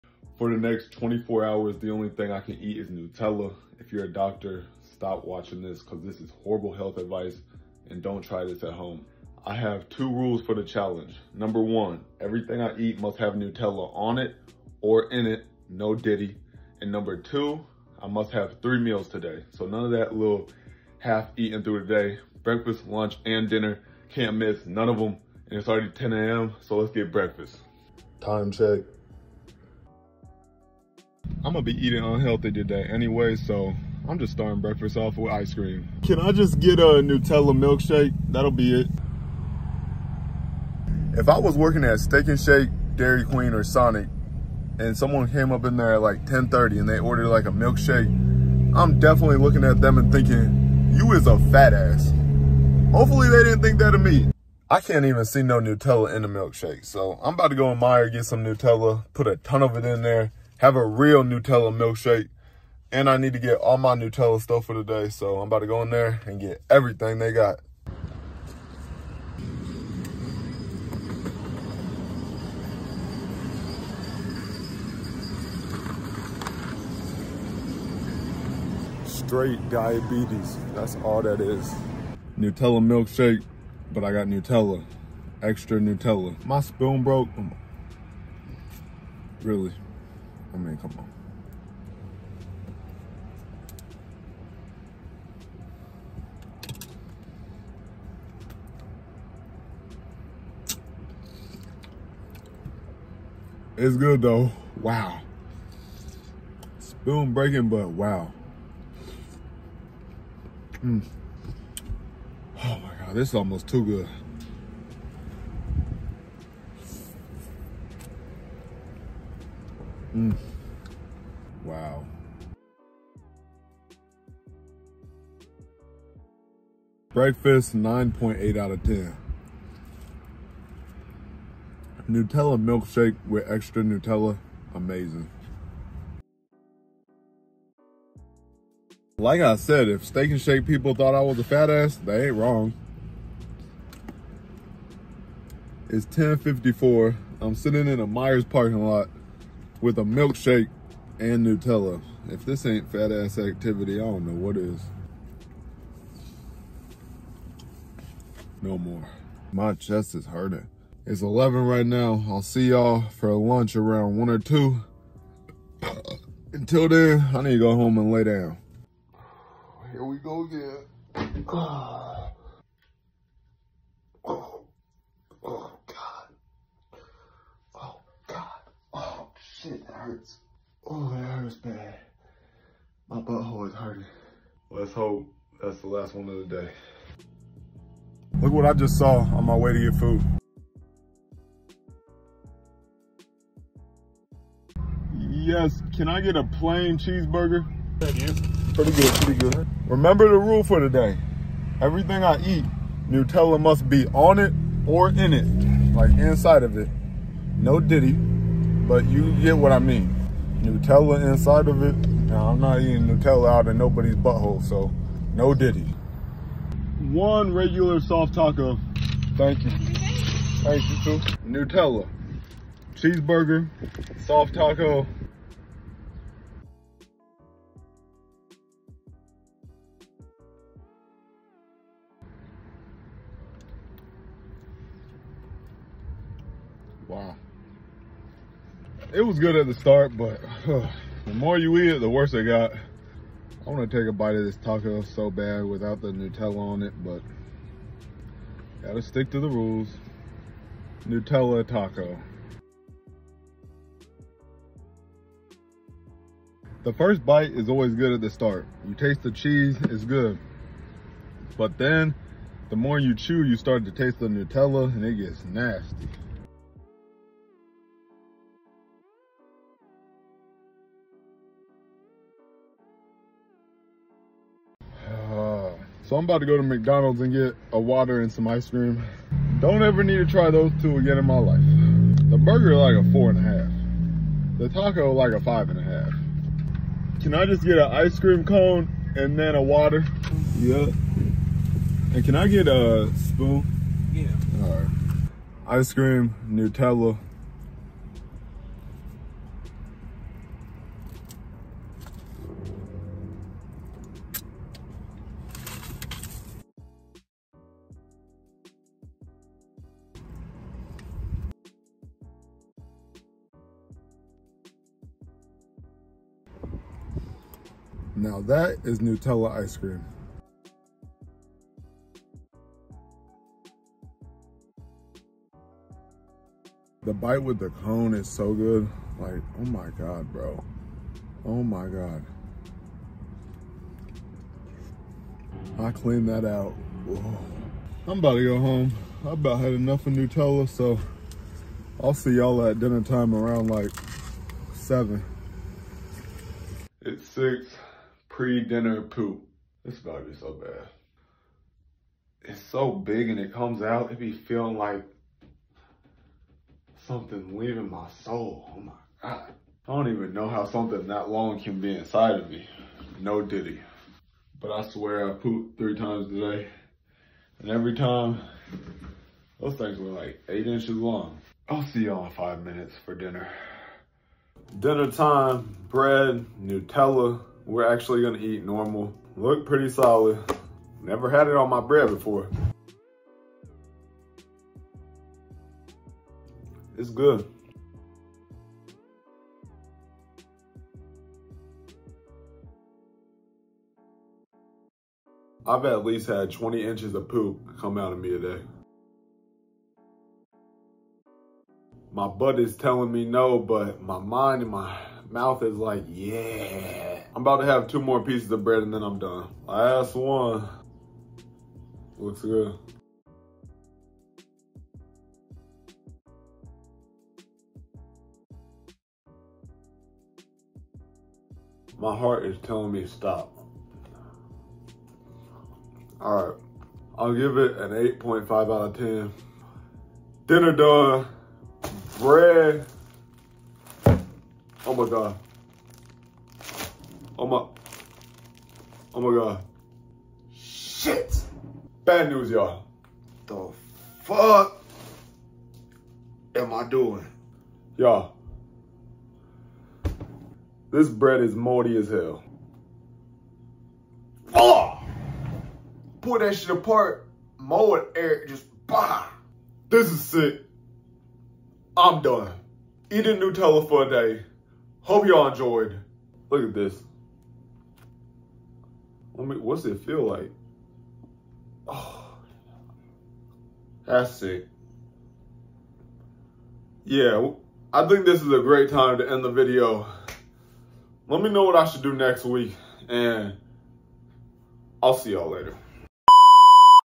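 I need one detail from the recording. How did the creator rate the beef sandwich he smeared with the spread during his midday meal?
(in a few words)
4.5.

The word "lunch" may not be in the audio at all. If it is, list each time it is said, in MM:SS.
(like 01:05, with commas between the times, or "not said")
00:22, 02:43.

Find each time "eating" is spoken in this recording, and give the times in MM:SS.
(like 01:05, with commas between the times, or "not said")
00:21, 00:31, 03:32, 07:43.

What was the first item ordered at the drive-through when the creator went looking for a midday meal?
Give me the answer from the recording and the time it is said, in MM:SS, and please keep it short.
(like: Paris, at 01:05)
plain cheeseburger, at 03:16.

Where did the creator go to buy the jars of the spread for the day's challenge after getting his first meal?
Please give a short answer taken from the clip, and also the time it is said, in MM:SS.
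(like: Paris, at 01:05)
Meijer, at 00:57.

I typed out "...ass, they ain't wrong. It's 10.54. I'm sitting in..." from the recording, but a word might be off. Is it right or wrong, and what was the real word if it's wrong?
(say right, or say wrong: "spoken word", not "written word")
right.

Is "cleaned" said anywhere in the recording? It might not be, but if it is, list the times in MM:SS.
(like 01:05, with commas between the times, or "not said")
05:35.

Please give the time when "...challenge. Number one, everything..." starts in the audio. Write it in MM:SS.
00:10.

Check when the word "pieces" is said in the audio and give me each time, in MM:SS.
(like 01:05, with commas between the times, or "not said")
06:48.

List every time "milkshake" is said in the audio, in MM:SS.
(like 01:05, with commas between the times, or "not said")
00:37, 00:47, 00:56, 01:01, 01:22, 02:12, 02:30.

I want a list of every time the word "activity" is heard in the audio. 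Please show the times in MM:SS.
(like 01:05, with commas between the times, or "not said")
02:33.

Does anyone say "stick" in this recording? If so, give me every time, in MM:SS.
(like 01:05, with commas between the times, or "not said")
04:09.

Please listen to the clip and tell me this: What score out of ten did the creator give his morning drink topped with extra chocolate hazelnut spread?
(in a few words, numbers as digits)
9.8.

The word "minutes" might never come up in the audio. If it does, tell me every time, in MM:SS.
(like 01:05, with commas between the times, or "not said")
06:12.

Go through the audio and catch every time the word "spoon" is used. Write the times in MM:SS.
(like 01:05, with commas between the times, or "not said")
01:26, 01:46, 04:53.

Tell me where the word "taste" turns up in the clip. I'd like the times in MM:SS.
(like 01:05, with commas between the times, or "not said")
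04:18, 04:23.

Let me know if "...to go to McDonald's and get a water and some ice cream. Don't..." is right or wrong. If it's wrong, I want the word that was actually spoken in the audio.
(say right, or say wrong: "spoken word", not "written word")
right.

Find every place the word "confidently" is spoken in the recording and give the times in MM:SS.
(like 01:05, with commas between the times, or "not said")
not said.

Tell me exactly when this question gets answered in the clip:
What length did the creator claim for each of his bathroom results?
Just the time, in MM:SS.
06:10.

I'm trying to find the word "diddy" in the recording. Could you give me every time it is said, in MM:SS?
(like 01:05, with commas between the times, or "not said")
03:27, 03:35, 06:03.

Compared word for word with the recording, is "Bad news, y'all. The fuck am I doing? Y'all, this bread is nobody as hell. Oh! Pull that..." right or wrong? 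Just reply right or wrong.
wrong.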